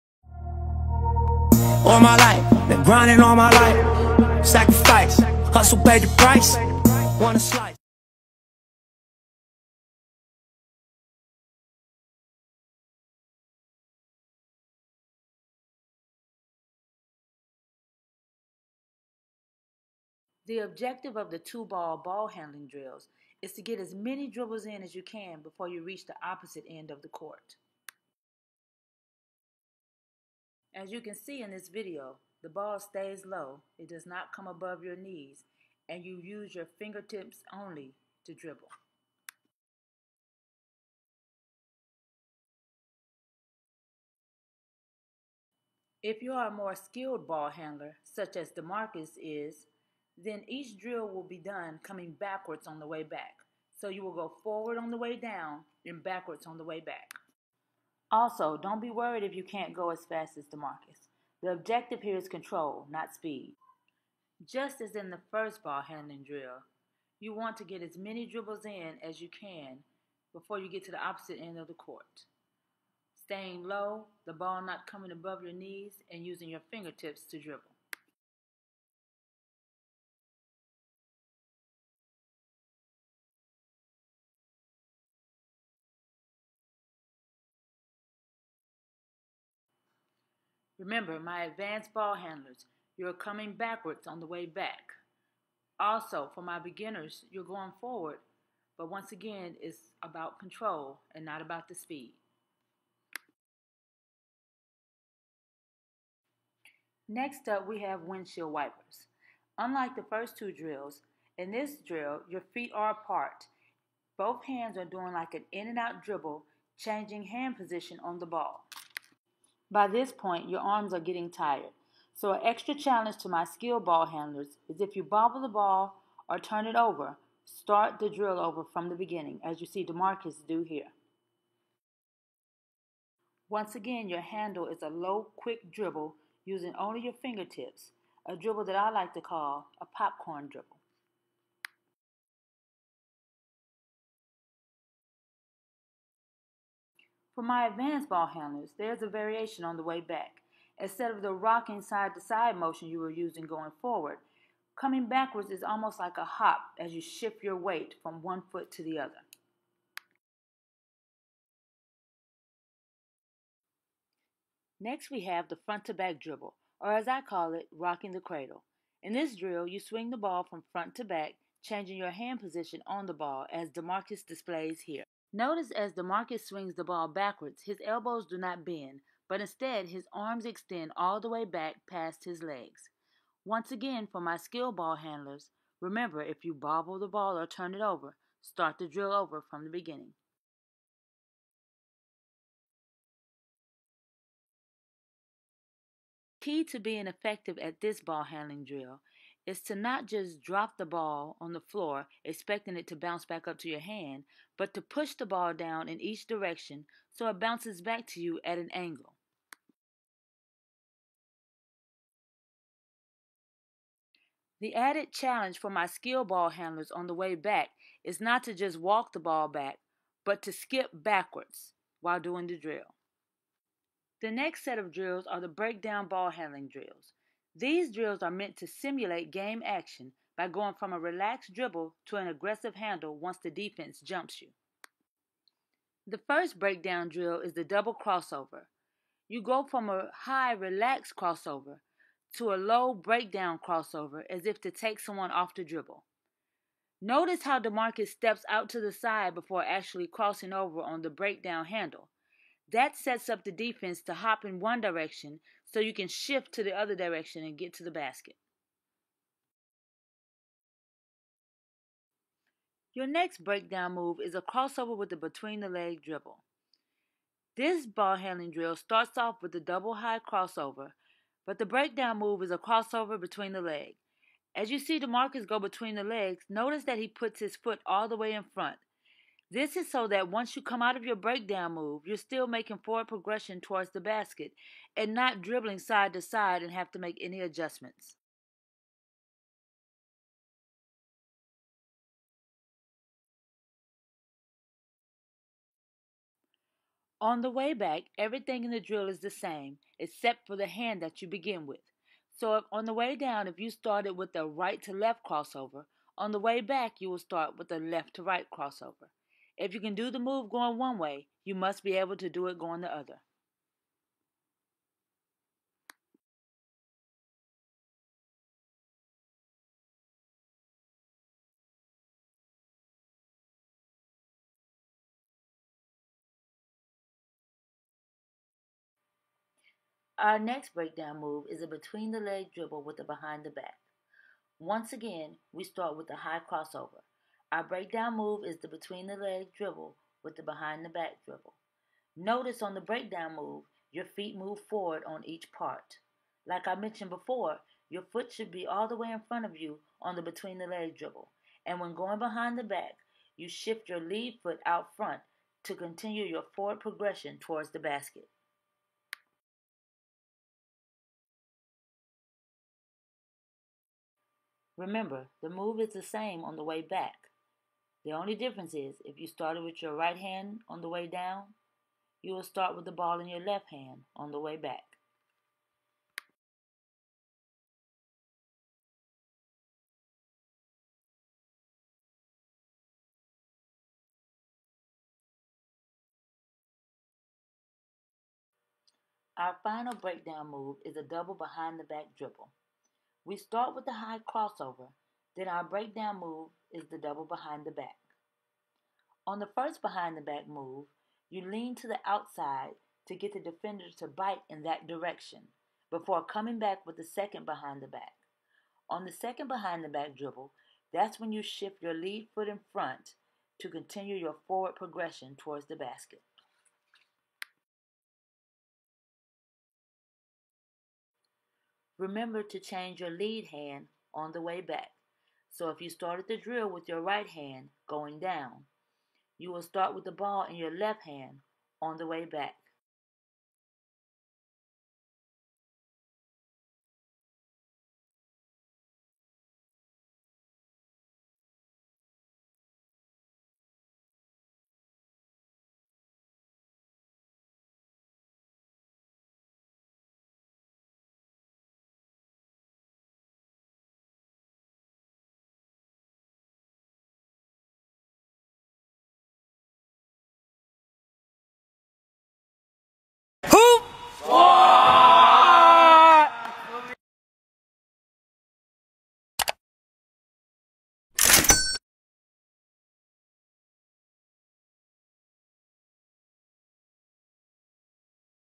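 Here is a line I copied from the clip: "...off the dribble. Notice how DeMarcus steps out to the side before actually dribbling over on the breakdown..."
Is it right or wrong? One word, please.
wrong.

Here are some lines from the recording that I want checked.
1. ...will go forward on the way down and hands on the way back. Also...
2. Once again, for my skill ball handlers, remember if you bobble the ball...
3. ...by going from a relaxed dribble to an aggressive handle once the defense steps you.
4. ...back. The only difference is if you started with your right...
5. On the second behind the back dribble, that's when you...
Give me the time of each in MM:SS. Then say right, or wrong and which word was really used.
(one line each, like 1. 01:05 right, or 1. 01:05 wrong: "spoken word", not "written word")
1. 00:54 wrong: "backwards", not "hands"
2. 03:03 right
3. 03:50 wrong: "jumps", not "steps"
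4. 06:06 right
5. 06:48 right.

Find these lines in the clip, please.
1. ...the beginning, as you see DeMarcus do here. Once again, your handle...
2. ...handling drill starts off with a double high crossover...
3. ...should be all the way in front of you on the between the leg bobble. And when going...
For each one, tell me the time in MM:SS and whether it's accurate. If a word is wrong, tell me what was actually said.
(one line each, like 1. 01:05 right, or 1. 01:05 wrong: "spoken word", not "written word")
1. 02:08 right
2. 04:28 right
3. 05:48 wrong: "dribble", not "bobble".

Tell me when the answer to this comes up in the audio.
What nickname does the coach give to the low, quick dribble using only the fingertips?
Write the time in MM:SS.
02:19.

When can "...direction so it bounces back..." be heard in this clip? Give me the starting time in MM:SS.
03:26.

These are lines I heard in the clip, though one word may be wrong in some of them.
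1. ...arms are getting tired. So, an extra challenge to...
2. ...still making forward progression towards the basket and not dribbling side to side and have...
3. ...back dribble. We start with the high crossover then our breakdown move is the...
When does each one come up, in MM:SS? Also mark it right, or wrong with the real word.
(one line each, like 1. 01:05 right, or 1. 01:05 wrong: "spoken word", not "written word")
1. 02:00 right
2. 04:42 right
3. 06:31 right.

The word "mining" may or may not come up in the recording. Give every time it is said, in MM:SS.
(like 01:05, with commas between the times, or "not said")
not said.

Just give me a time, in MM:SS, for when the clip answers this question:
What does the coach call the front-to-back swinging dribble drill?
02:47.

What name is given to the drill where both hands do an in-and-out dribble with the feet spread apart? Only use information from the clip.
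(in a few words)
Windshield wipers.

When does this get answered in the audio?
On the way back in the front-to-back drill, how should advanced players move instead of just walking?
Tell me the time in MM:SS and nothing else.
03:40.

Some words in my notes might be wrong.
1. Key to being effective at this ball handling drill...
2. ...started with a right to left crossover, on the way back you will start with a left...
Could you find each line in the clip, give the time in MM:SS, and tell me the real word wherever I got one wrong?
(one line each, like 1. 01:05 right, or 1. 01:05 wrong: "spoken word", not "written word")
1. 03:16 right
2. 05:03 right.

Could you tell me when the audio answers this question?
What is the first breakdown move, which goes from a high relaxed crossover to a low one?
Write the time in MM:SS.
03:57.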